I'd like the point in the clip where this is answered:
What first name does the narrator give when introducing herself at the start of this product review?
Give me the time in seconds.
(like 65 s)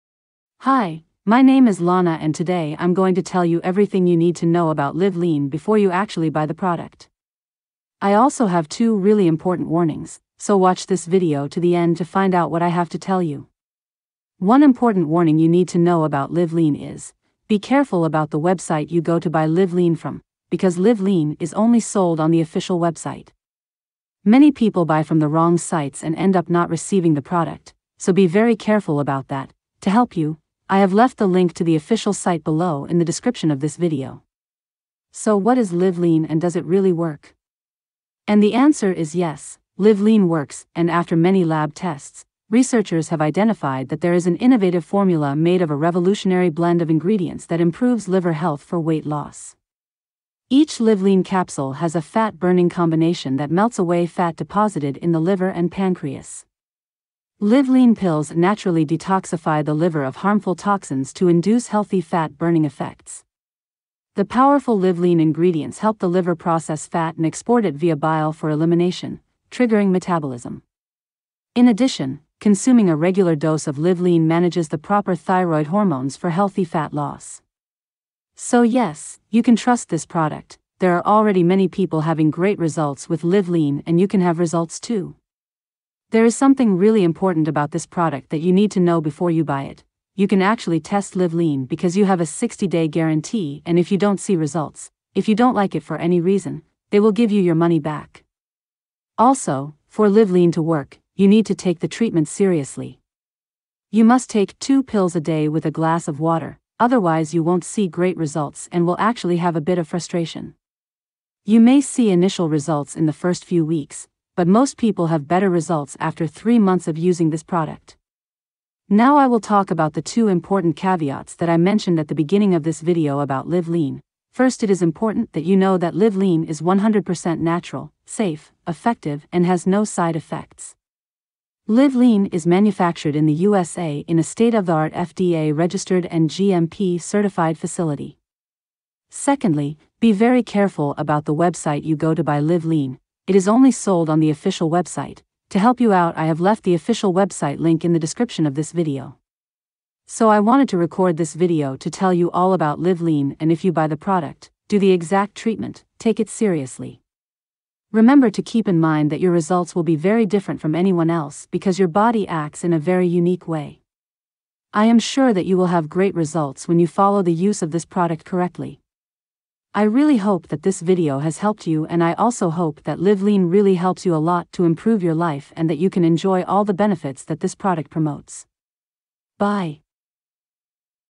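1 s.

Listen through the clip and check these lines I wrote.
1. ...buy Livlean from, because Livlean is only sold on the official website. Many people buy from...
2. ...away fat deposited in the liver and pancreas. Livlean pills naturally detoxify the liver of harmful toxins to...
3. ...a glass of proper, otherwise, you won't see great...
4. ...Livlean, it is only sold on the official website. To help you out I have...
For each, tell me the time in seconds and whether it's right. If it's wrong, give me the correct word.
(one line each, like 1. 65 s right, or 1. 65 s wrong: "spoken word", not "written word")
1. 19 s right
2. 53 s right
3. 105 s wrong: "water", not "proper"
4. 142 s right.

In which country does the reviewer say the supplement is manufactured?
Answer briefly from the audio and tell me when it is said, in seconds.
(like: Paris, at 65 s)
USA, at 133 s.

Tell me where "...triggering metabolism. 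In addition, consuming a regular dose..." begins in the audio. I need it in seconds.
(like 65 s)
69 s.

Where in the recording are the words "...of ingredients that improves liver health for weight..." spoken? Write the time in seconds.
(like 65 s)
46 s.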